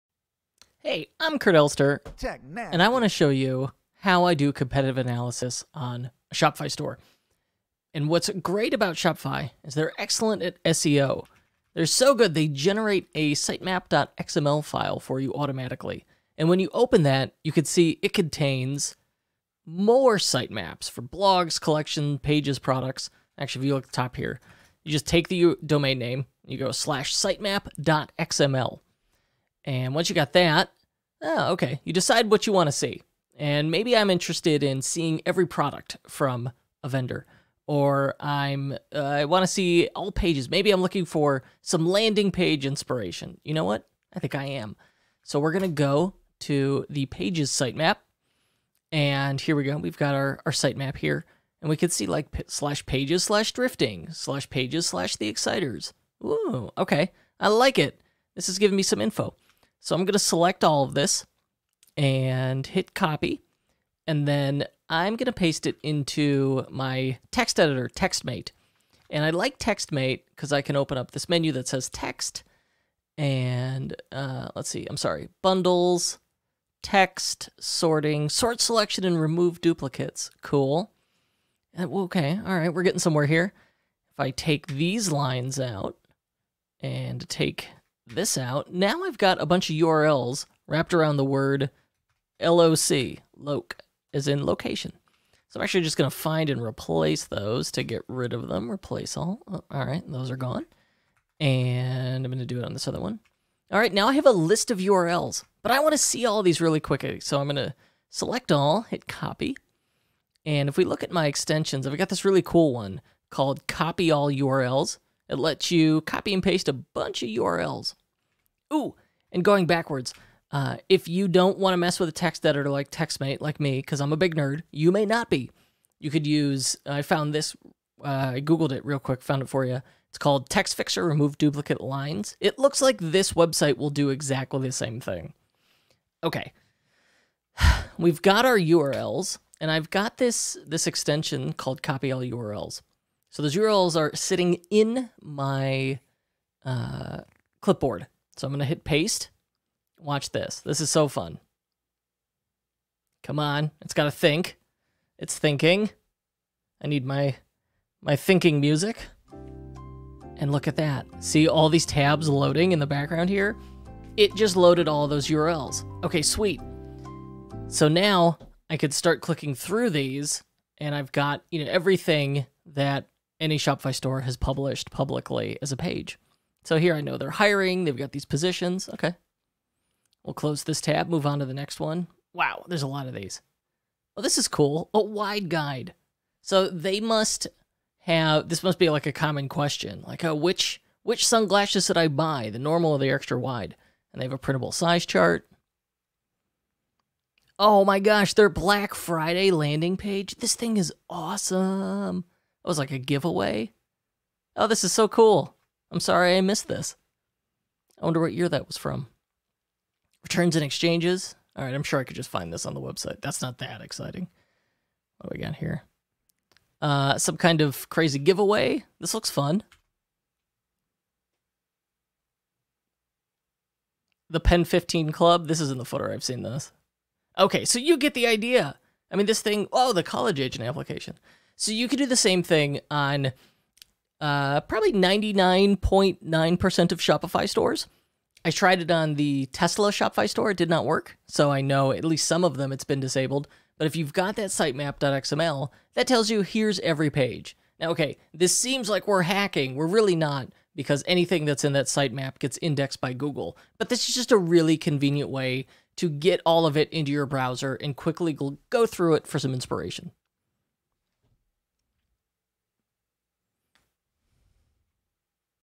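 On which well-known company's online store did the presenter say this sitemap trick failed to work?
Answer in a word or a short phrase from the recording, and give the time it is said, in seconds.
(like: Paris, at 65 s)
Tesla, at 239 s.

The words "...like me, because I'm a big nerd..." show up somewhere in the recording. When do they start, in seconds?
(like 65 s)
123 s.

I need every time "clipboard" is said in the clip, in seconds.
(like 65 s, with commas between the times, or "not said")
147 s.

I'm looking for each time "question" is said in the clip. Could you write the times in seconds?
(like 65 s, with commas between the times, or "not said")
189 s.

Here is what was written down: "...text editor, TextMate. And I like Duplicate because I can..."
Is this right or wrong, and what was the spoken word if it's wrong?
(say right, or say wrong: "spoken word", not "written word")
wrong: "TextMate", not "Duplicate".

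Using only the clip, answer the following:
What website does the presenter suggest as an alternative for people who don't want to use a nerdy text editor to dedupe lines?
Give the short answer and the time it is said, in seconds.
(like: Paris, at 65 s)
Text Fixer, at 130 s.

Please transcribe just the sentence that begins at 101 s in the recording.
And I'm going to do it on this other one.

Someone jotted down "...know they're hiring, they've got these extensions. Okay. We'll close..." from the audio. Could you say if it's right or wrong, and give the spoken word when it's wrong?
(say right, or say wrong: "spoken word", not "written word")
wrong: "positions", not "extensions".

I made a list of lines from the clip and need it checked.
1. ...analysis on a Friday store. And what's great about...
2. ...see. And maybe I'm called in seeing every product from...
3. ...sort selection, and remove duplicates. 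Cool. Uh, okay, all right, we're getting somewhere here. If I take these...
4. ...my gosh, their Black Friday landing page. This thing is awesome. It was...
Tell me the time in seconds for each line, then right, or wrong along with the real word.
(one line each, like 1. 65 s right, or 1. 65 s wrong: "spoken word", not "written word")
1. 4 s wrong: "Shopify", not "Friday"
2. 32 s wrong: "interested", not "called"
3. 78 s right
4. 197 s right.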